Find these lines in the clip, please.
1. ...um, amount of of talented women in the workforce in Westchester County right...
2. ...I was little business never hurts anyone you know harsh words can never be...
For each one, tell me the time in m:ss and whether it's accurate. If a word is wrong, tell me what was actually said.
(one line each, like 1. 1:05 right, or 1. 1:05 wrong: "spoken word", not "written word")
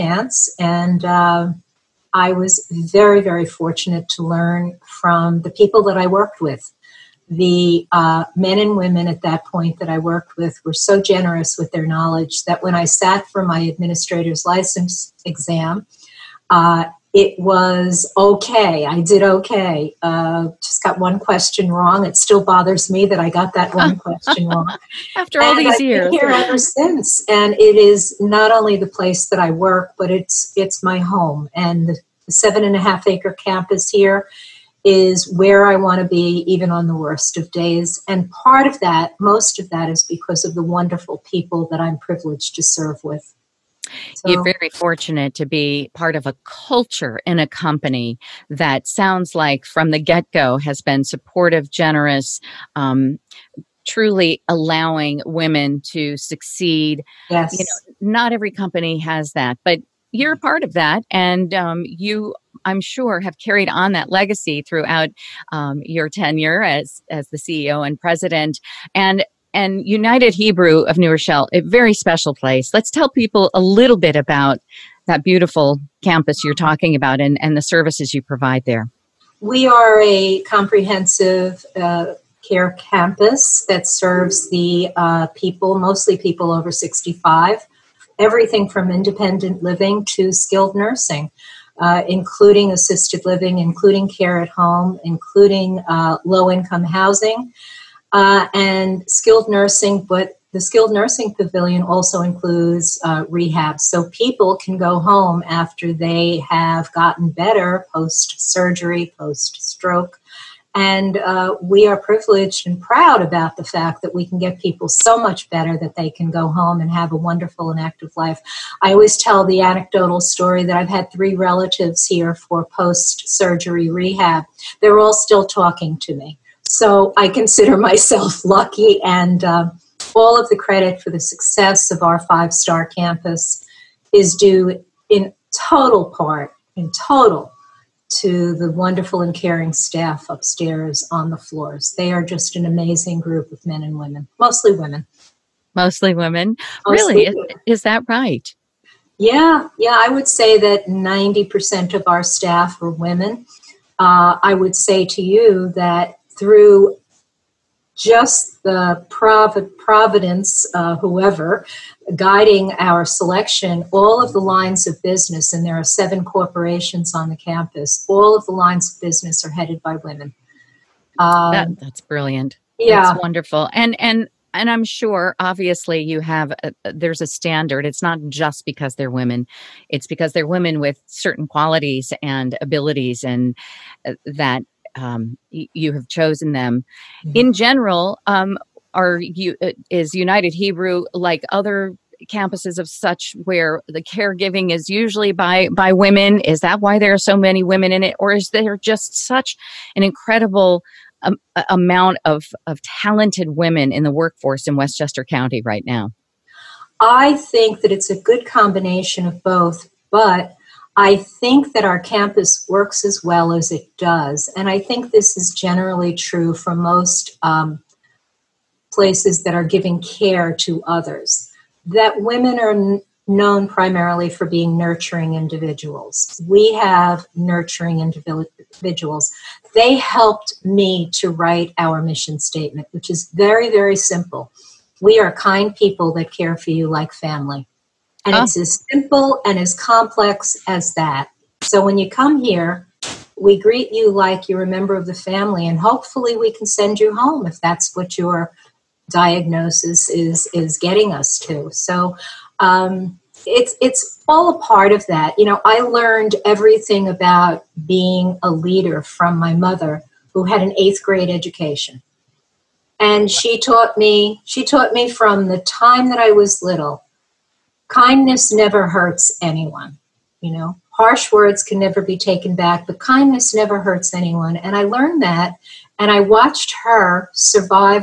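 1. 3:21 right
2. 4:26 wrong: "kindness", not "business".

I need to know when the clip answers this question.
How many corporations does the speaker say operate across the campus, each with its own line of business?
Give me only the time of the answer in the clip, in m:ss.
2:45.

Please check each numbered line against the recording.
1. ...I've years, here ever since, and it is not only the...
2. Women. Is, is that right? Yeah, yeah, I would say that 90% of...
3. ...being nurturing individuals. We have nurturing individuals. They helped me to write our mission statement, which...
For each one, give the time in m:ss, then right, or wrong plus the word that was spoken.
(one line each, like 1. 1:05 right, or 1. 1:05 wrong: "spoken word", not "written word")
1. 0:25 right
2. 2:27 right
3. 3:44 right.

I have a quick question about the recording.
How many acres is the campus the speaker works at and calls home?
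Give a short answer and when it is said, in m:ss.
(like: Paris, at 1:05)
7.5 acres, at 0:32.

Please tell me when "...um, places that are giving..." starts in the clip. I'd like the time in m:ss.
3:37.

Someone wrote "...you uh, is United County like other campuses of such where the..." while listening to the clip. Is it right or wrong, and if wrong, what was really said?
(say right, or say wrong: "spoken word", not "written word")
wrong: "Hebrew", not "County".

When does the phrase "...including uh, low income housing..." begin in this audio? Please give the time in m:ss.
1:35.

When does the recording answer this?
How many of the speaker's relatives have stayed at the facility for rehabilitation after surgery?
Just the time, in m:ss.
2:01.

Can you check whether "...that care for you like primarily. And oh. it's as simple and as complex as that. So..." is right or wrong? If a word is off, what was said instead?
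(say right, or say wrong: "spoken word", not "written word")
wrong: "family", not "primarily".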